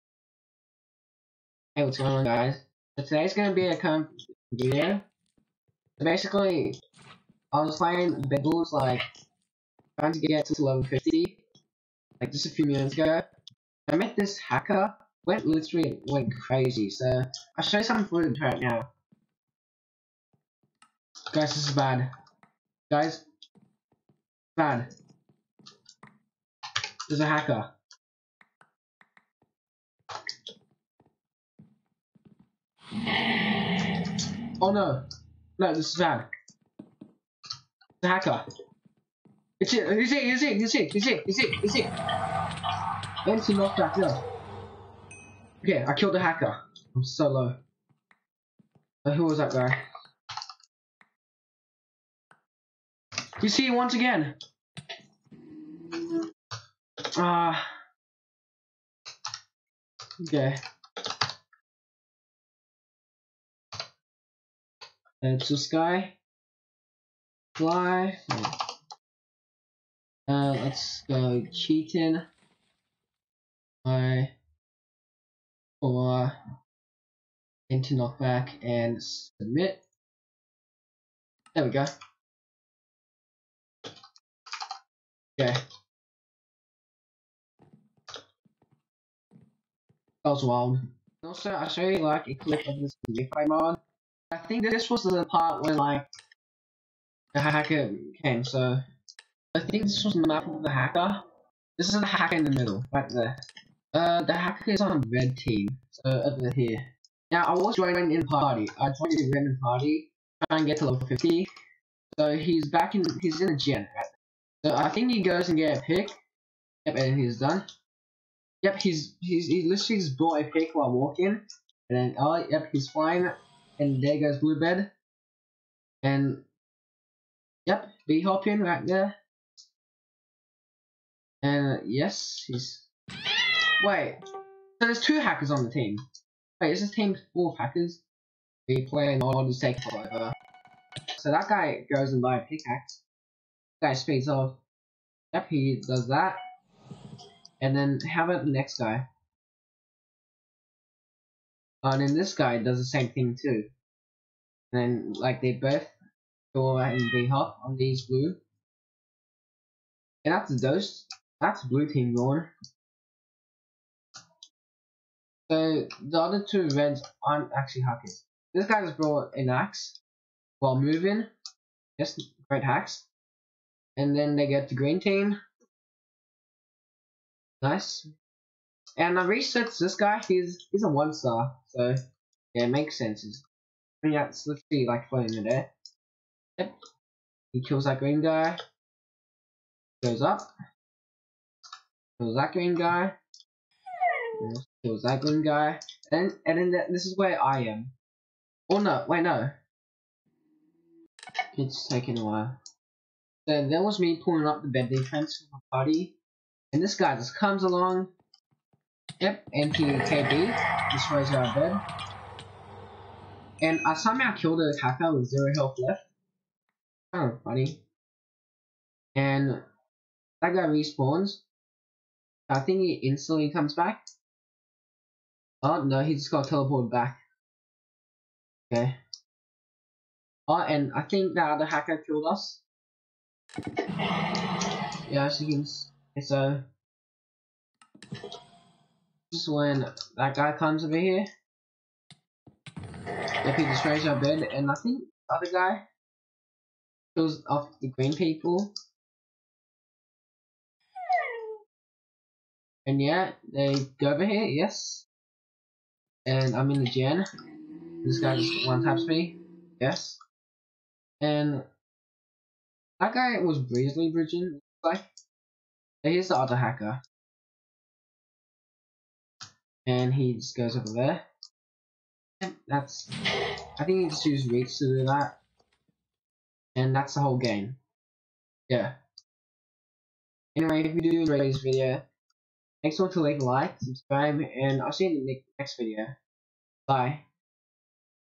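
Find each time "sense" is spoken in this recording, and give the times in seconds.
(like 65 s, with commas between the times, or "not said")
182 s.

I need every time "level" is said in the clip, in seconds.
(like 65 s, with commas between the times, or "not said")
10 s, 110 s.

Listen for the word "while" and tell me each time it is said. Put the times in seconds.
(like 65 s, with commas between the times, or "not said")
120 s, 170 s, 202 s.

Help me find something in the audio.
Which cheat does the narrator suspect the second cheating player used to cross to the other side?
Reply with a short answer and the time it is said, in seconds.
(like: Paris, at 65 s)
Reach, at 274 s.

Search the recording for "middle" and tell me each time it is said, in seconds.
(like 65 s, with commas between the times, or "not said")
102 s.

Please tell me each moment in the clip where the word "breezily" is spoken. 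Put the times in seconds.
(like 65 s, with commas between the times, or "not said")
263 s.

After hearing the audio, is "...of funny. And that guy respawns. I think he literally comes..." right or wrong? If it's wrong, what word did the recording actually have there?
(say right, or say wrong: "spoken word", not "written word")
wrong: "instantly", not "literally".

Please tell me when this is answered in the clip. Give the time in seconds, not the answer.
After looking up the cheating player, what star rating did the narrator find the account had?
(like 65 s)
180 s.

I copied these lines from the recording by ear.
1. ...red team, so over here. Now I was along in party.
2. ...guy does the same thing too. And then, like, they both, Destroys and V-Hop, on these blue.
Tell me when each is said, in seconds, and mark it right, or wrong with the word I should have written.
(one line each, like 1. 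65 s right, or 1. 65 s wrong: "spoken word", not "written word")
1. 105 s wrong: "joining", not "along"
2. 152 s wrong: "Dora", not "Destroys".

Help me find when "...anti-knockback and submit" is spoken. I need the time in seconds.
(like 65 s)
77 s.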